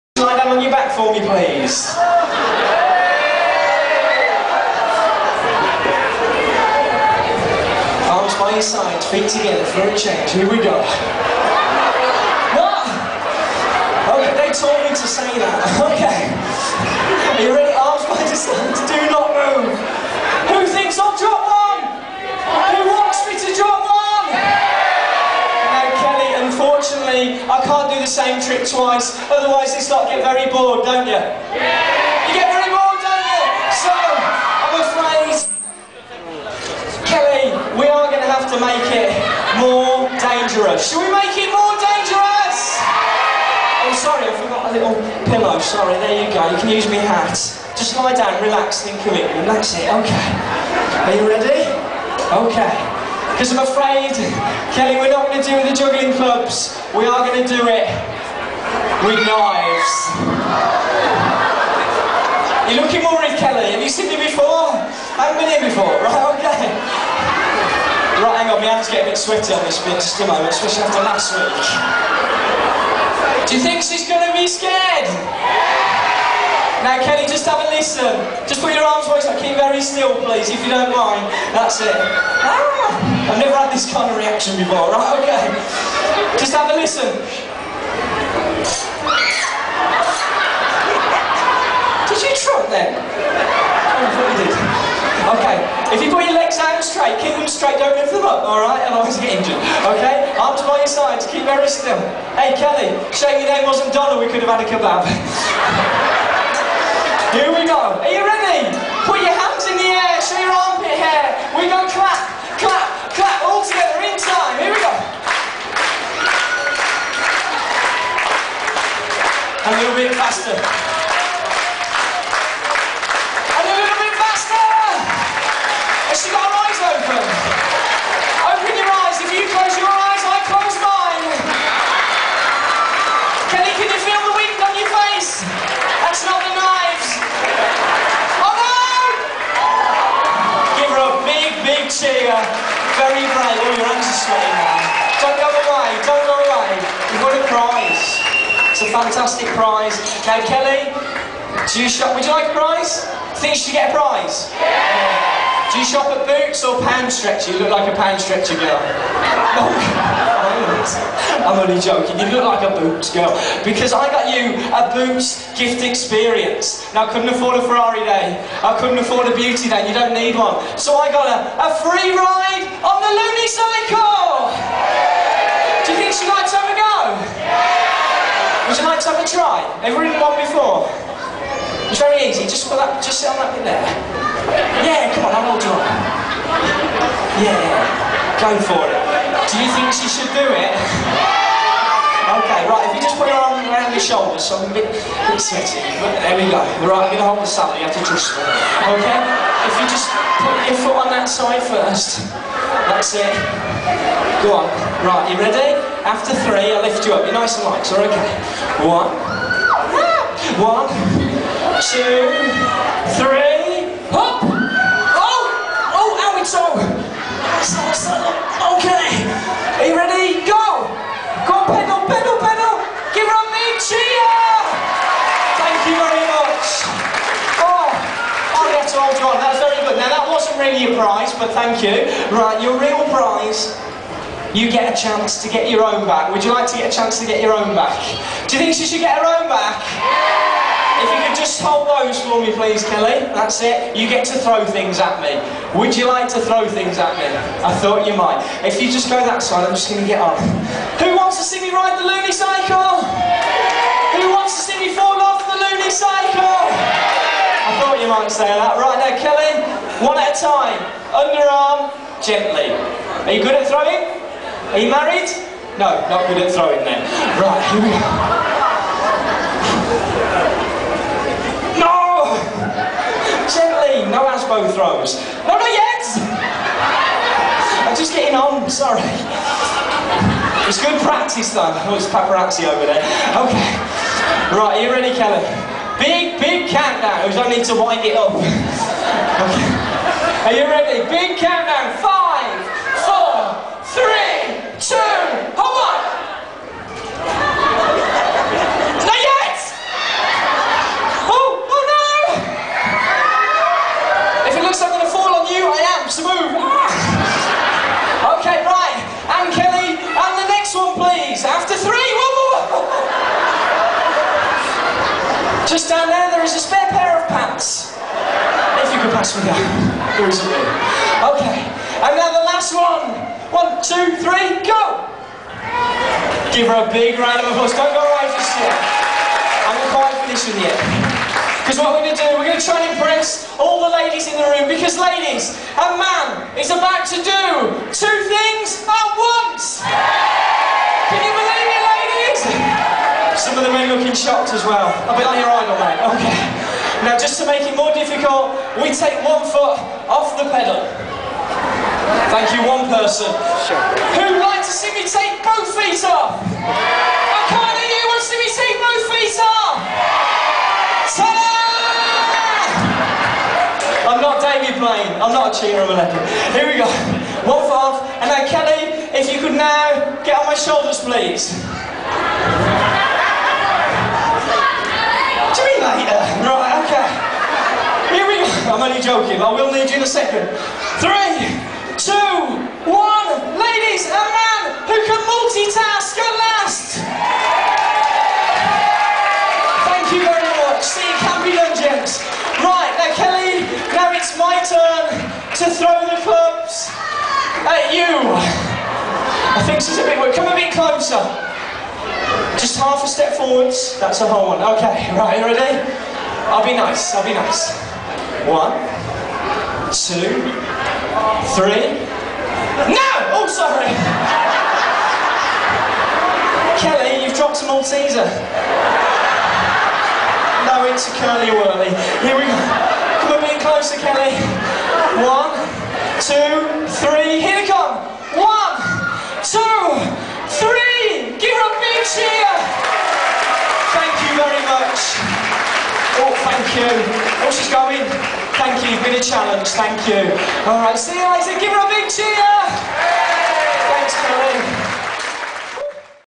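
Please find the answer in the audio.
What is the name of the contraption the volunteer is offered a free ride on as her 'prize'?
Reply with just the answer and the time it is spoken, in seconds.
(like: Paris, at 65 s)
Looney Cycle, at 173 s.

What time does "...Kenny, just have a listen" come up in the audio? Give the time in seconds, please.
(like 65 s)
76 s.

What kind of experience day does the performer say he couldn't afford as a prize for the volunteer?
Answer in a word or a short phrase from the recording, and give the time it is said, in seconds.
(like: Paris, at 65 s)
Ferrari day, at 167 s.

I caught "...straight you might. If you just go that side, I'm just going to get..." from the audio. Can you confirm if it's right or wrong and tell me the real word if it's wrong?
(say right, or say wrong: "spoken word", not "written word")
wrong: "thought", not "straight".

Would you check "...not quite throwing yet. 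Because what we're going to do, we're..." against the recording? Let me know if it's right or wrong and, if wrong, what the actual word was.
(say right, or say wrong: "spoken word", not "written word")
wrong: "finishing", not "throwing".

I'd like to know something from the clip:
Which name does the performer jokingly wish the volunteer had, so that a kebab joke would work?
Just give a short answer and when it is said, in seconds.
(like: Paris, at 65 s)
Donna, at 103 s.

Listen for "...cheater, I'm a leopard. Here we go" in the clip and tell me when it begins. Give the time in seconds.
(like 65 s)
365 s.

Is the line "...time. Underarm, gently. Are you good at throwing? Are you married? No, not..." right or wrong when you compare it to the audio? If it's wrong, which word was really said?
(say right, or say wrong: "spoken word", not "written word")
right.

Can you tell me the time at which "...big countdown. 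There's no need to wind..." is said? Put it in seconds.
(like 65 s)
286 s.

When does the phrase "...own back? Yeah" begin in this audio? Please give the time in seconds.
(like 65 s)
239 s.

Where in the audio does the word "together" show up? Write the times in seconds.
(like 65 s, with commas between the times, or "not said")
9 s, 113 s.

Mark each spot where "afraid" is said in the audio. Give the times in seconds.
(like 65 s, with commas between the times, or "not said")
34 s, 53 s.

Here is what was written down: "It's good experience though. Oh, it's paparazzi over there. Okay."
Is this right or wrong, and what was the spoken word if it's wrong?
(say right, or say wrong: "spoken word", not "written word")
wrong: "practice", not "experience".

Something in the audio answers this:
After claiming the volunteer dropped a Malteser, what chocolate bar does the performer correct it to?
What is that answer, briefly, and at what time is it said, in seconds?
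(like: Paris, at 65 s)
Curly Wurly, at 421 s.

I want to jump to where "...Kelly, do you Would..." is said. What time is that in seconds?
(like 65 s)
150 s.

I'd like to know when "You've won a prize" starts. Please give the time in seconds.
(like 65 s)
147 s.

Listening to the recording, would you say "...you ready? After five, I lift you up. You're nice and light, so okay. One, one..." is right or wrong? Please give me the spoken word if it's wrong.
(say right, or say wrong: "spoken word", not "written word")
wrong: "three", not "five".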